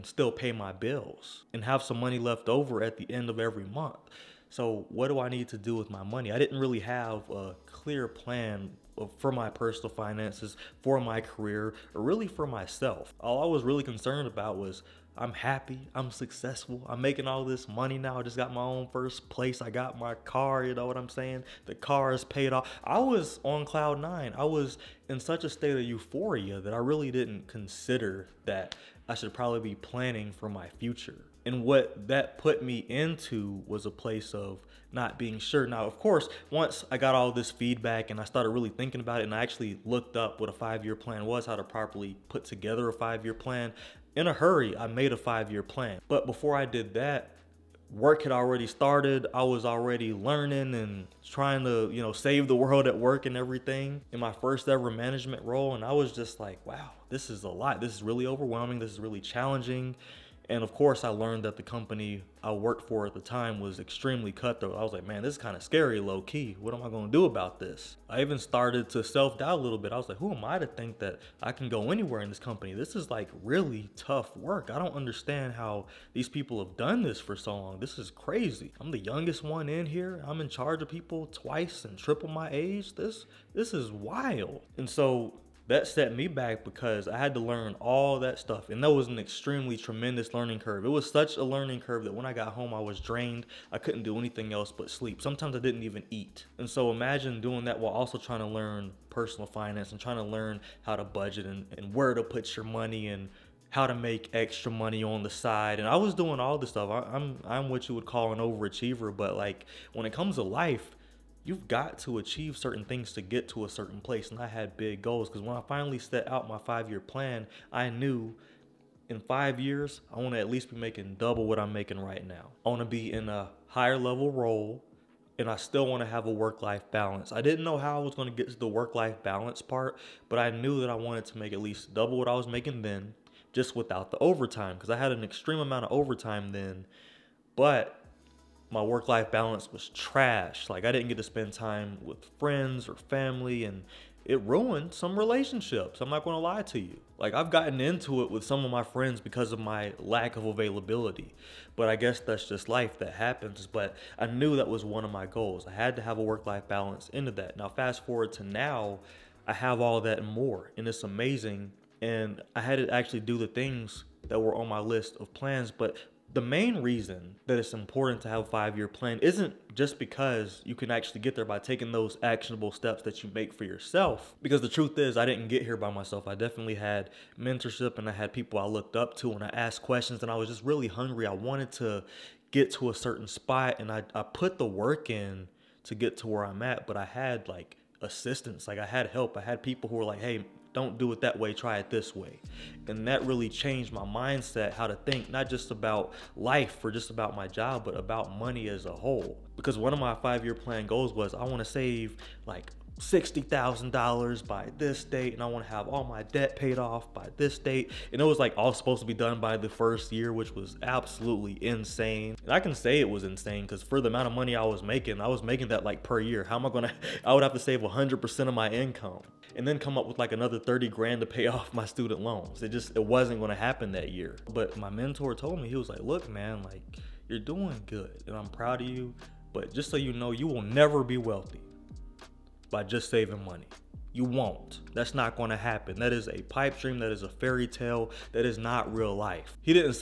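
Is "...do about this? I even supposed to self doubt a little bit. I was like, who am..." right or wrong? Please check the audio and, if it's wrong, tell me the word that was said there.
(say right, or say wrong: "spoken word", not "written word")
wrong: "started", not "supposed".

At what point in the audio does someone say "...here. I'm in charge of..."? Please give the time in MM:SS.
01:19.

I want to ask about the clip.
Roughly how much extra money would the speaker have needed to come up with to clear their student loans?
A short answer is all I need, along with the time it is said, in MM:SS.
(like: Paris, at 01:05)
30 grand, at 03:40.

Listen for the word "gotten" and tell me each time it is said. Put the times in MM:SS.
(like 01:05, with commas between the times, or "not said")
02:27.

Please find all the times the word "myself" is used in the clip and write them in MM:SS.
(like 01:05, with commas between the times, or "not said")
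00:12, 02:55.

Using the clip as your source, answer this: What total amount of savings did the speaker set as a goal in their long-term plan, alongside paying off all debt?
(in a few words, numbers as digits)
$60,000.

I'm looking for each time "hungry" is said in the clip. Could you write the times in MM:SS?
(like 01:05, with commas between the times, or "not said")
03:00.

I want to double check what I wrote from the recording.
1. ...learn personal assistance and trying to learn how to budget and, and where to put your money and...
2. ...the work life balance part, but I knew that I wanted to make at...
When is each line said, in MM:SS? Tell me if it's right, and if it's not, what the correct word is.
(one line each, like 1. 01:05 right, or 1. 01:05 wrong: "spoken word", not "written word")
1. 01:38 wrong: "finance", not "assistance"
2. 02:08 right.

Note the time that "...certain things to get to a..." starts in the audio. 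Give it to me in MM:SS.
01:52.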